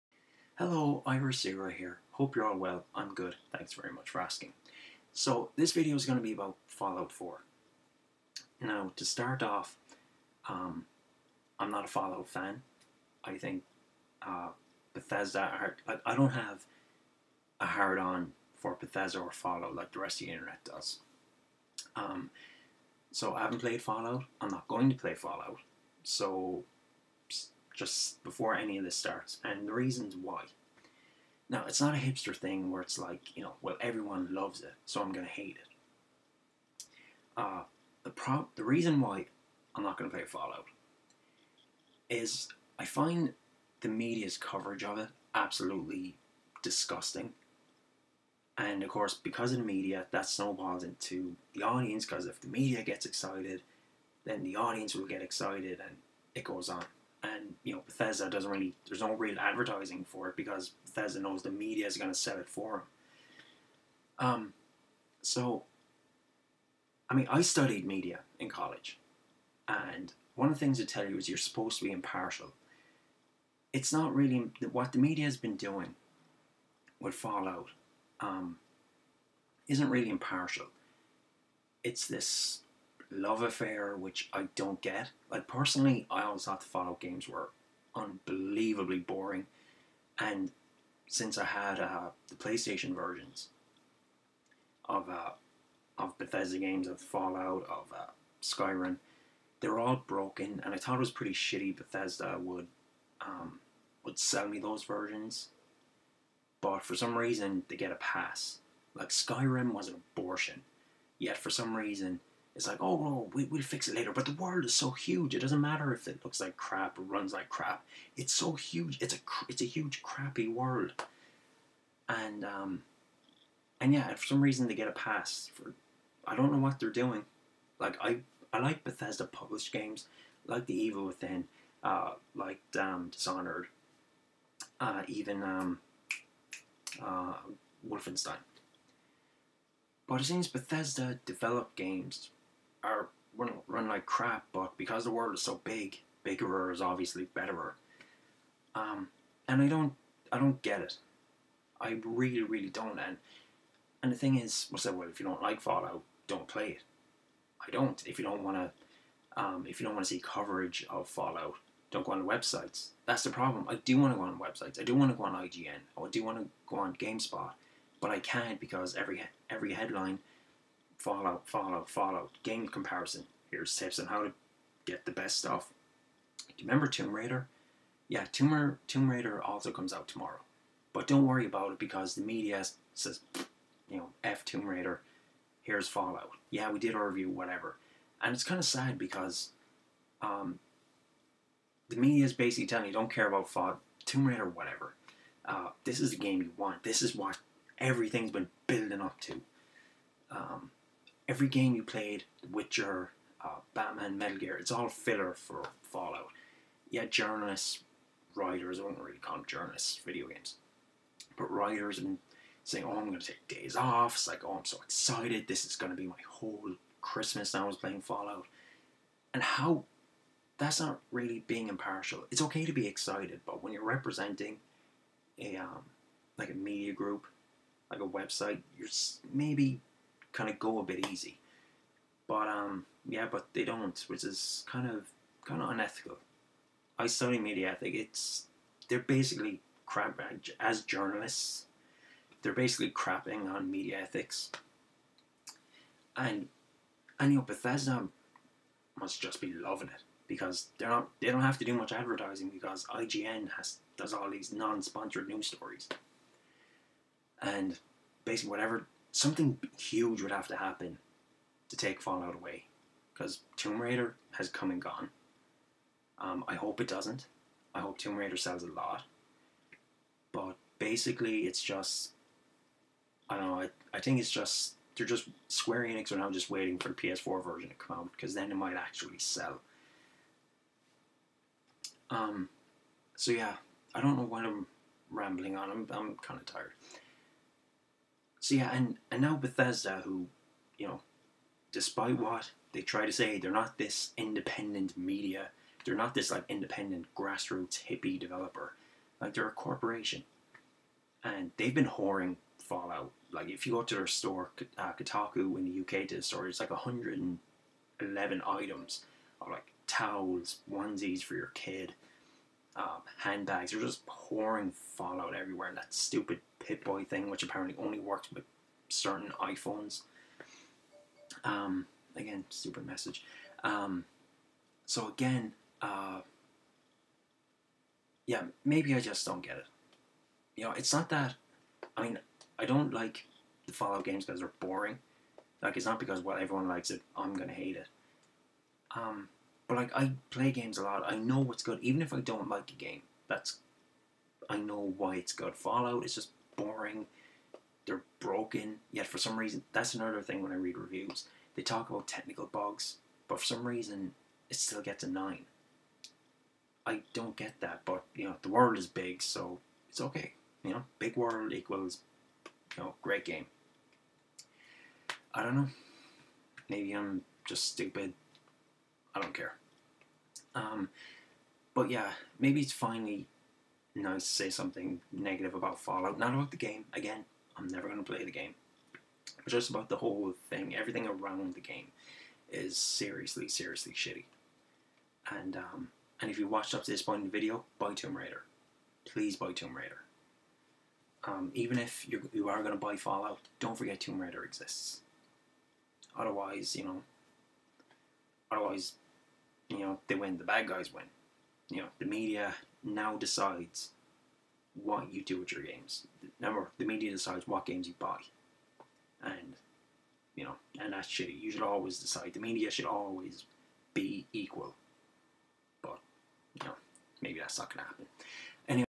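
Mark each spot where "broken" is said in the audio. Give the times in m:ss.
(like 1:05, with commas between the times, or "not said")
1:40, 5:48.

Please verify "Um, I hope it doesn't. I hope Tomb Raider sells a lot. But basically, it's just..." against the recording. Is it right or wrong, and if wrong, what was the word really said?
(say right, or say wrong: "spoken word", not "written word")
right.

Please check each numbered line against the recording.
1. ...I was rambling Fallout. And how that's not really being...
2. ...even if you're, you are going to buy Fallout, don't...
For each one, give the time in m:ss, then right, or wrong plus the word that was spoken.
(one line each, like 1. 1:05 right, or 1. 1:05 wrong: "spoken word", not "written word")
1. 3:37 wrong: "playing", not "rambling"
2. 6:31 right.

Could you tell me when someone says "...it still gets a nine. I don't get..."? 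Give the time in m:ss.
5:54.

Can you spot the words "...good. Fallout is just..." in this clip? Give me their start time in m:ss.
5:45.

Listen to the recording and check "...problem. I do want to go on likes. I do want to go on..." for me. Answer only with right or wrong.
wrong.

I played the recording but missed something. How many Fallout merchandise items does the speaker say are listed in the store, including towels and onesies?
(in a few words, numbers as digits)
111.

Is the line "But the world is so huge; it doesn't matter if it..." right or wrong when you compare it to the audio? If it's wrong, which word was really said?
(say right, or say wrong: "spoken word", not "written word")
right.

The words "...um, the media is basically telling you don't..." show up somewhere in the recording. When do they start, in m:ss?
3:10.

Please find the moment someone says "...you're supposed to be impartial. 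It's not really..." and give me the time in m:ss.
1:11.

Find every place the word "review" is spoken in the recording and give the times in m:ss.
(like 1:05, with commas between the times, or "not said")
3:07, 5:50.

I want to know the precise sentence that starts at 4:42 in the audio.
Um, so yeah, I don't know what I'm rambling on.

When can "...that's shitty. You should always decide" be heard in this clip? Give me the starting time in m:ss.
6:50.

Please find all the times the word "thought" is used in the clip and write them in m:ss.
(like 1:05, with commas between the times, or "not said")
1:26, 1:40.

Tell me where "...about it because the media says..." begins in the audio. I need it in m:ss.
3:01.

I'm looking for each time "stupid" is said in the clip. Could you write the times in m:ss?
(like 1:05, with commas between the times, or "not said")
5:15, 5:22, 6:07.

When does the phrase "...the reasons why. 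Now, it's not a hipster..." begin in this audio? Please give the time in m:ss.
0:29.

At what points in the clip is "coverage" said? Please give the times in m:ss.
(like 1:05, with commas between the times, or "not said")
0:44, 2:40.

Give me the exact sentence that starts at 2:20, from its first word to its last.
But it seems Bethesda develop games are run, run like crap, but because the world is so big, bigger is obviously betterer.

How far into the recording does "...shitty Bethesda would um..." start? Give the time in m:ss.
1:41.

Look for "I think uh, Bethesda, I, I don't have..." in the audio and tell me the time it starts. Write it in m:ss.
0:13.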